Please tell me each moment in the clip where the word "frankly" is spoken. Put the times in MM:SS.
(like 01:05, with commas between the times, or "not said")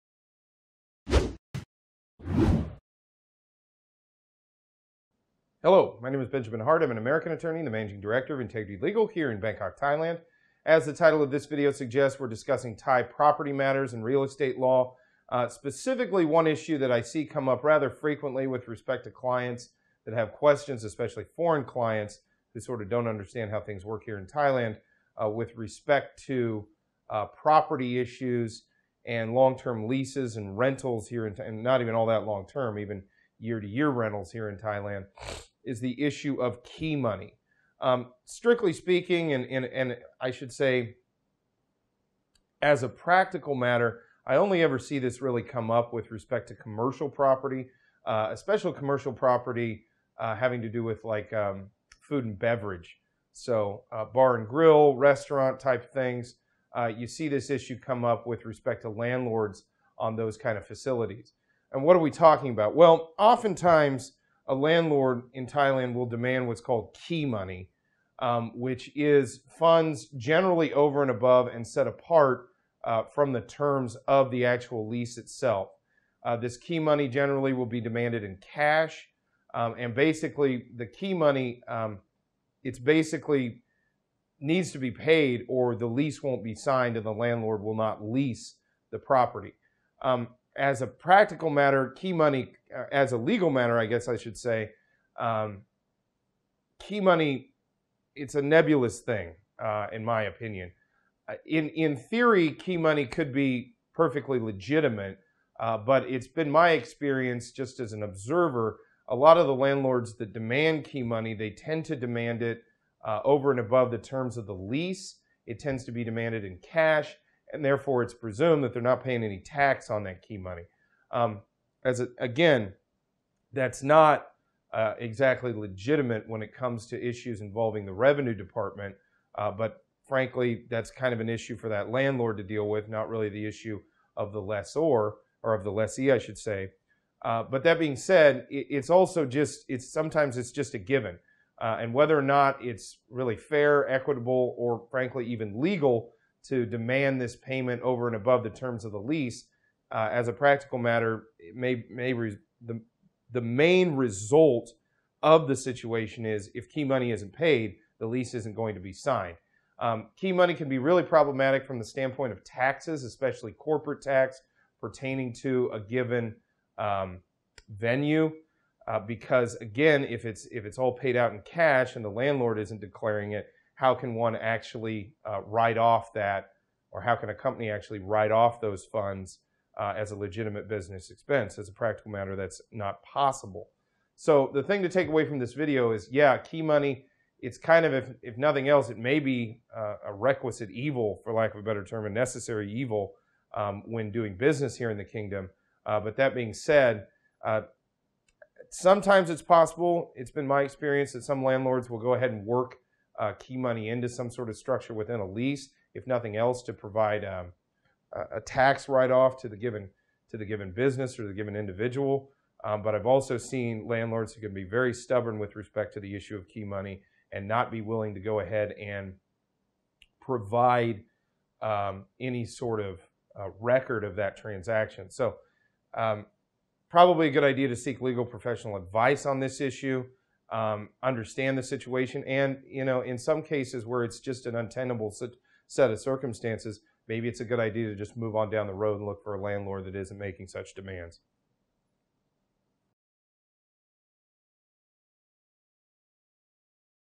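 02:10, 02:24.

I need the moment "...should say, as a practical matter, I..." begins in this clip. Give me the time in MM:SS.
00:40.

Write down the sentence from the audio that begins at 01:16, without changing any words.
Uh, this key money generally will be demanded in cash.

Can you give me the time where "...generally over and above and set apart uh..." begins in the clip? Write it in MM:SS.
01:10.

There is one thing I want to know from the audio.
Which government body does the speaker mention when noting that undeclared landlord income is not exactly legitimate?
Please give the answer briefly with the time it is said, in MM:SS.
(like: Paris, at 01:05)
the revenue department, at 02:07.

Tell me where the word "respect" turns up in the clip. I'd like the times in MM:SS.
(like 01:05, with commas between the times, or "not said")
00:18, 00:25, 00:46, 00:58, 03:35.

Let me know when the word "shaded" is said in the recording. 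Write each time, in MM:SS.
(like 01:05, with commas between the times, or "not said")
not said.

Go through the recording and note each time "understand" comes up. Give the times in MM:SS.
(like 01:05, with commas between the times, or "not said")
00:23, 03:51.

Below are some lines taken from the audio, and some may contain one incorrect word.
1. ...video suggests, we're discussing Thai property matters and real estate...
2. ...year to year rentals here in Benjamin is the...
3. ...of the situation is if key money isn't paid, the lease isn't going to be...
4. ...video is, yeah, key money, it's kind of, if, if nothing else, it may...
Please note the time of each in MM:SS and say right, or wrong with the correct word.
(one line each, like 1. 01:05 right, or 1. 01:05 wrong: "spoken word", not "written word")
1. 00:11 right
2. 00:33 wrong: "Thailand", not "Benjamin"
3. 02:35 right
4. 03:05 right.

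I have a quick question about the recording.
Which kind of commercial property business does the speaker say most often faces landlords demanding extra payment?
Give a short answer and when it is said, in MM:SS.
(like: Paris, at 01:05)
food and beverage, at 00:52.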